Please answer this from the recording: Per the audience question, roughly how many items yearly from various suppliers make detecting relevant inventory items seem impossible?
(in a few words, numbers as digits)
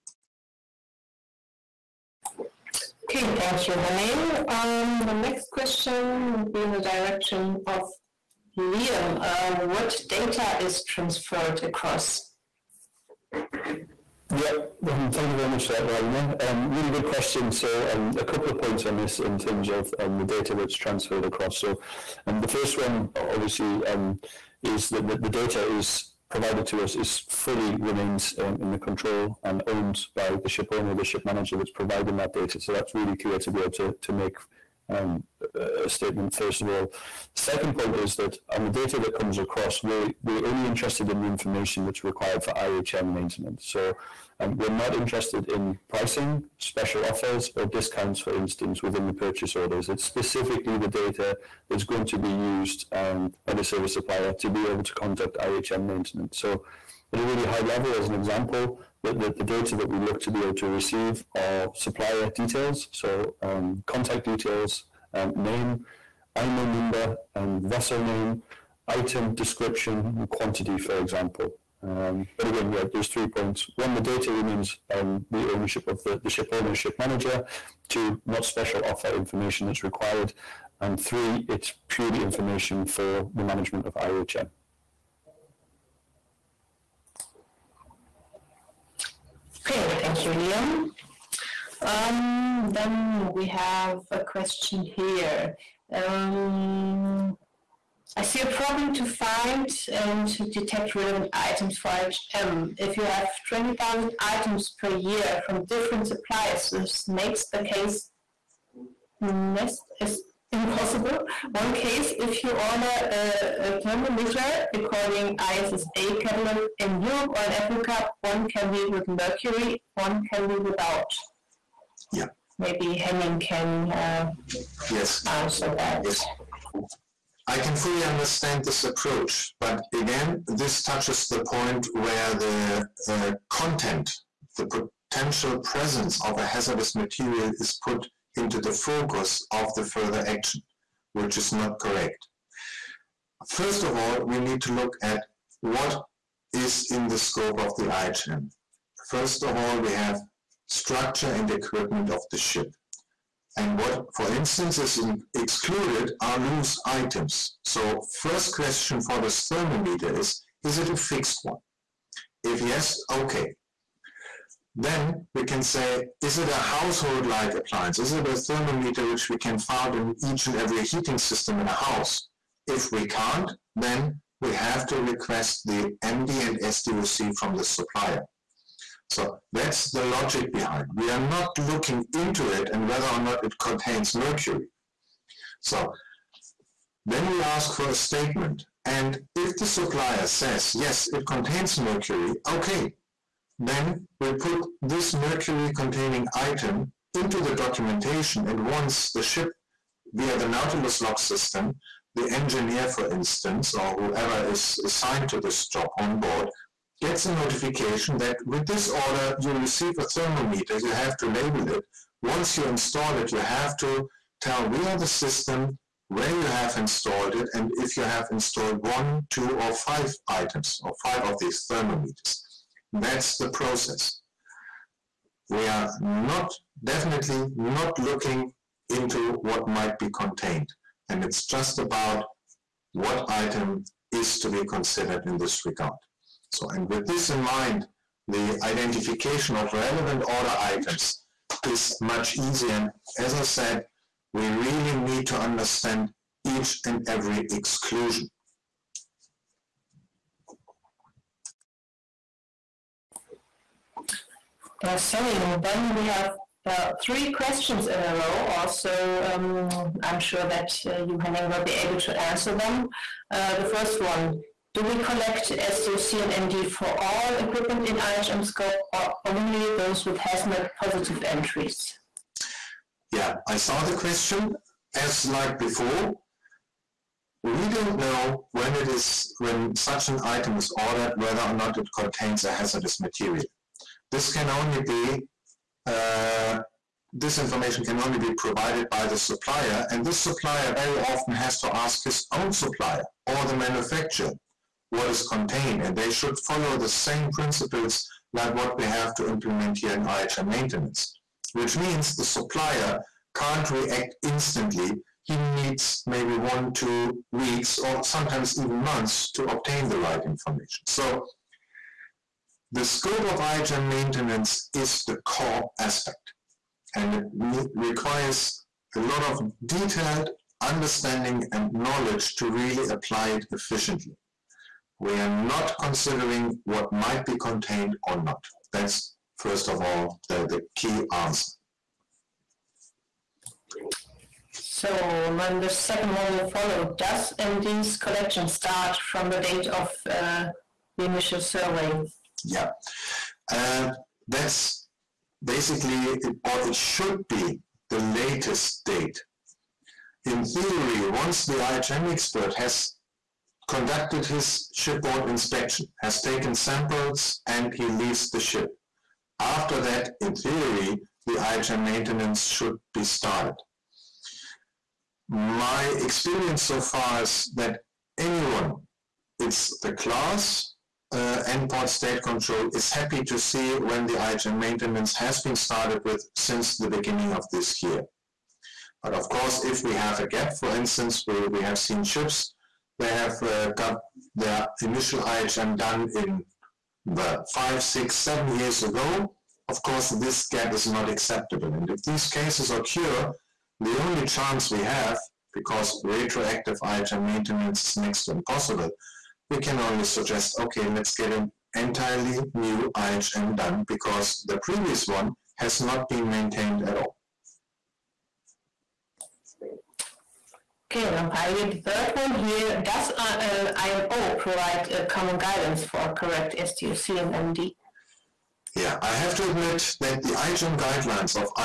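20,000.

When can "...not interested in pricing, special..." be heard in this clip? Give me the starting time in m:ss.
0:44.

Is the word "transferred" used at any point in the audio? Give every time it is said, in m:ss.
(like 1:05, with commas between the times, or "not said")
0:10, 0:20.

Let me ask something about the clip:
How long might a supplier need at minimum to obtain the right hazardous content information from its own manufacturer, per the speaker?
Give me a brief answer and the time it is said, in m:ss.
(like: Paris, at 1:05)
one, two weeks, at 5:06.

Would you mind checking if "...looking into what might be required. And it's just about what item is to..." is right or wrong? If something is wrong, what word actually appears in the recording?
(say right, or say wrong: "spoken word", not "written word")
wrong: "contained", not "required".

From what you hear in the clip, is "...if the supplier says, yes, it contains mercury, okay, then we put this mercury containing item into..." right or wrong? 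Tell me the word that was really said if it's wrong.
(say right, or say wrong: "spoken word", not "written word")
right.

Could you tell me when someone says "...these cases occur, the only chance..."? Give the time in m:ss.
6:32.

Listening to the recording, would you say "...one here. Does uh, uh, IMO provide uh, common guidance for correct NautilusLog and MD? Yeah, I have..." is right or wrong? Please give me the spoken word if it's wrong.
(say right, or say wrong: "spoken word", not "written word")
wrong: "SDOC", not "NautilusLog".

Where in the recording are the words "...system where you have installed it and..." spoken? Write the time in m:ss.
3:35.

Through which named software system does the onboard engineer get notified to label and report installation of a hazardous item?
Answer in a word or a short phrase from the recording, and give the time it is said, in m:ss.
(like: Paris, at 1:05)
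NautilusLog, at 3:20.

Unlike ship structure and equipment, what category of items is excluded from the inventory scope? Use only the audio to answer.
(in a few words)
loose items.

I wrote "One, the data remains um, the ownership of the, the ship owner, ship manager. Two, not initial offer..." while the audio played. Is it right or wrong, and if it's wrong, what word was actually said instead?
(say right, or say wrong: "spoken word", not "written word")
wrong: "special", not "initial".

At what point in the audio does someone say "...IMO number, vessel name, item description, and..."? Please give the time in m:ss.
1:06.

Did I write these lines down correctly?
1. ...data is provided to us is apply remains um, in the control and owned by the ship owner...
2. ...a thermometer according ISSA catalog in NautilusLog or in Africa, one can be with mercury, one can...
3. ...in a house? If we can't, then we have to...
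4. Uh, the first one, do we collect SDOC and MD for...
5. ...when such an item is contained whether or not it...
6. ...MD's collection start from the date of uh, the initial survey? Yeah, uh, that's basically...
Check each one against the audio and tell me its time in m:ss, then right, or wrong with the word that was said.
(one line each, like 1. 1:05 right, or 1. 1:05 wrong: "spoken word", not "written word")
1. 0:25 wrong: "fully", not "apply"
2. 1:53 wrong: "Europe", not "NautilusLog"
3. 2:51 right
4. 4:23 right
5. 4:39 wrong: "ordered", not "contained"
6. 5:37 right.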